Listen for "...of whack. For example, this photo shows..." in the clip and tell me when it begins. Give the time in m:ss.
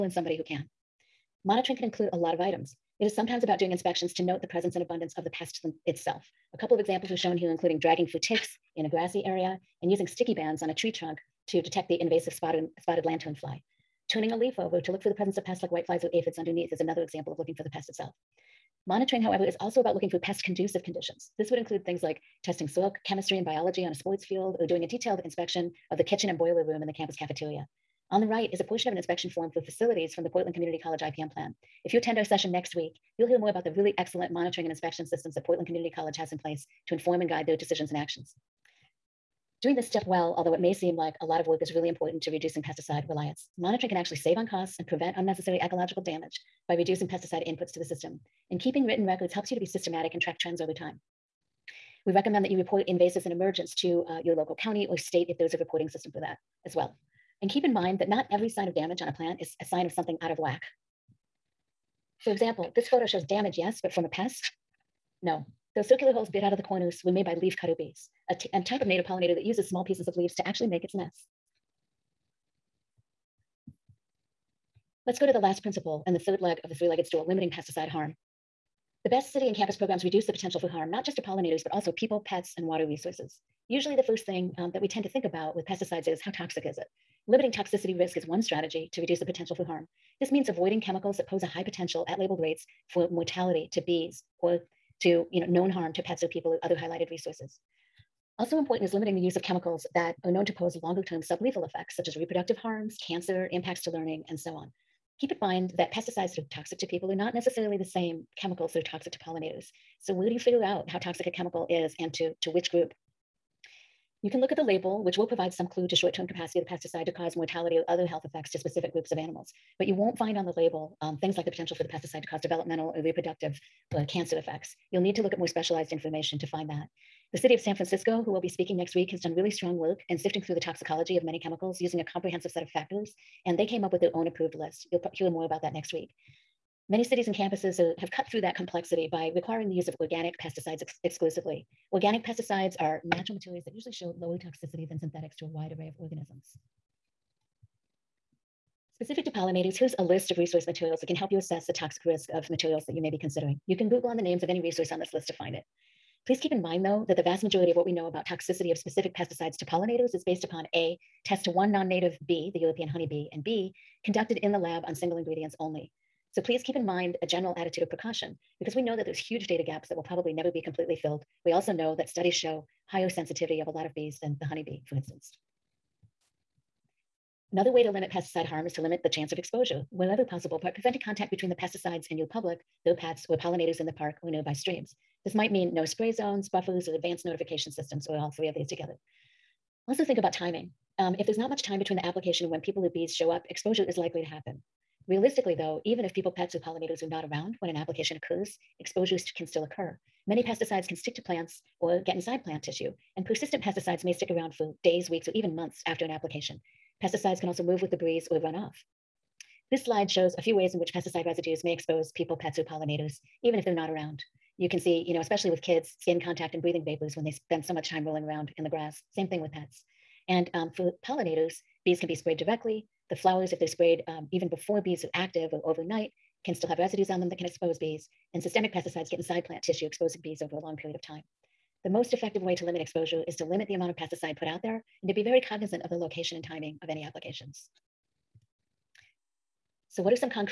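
1:00.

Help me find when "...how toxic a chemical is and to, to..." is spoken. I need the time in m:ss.
1:50.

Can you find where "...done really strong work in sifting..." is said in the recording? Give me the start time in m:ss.
2:09.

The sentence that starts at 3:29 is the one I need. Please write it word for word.
This slide shows a few ways in which pesticide residues may expose people, pets, or pollinators, even if they're not around.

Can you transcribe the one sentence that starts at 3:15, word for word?
Realistically, though, even if people, pets, or pollinators are not around when an application occurs, exposures can still occur.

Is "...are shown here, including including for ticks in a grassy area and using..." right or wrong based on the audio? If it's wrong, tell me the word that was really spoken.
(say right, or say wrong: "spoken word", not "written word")
wrong: "dragging", not "including".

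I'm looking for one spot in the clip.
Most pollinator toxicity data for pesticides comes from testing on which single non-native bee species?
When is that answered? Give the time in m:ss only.
2:42.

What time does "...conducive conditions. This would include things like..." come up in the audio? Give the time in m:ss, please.
0:20.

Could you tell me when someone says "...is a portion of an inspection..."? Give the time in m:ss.
0:28.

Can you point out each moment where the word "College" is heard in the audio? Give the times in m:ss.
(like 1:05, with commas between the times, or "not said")
0:30, 0:35.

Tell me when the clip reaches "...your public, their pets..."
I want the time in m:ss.
3:02.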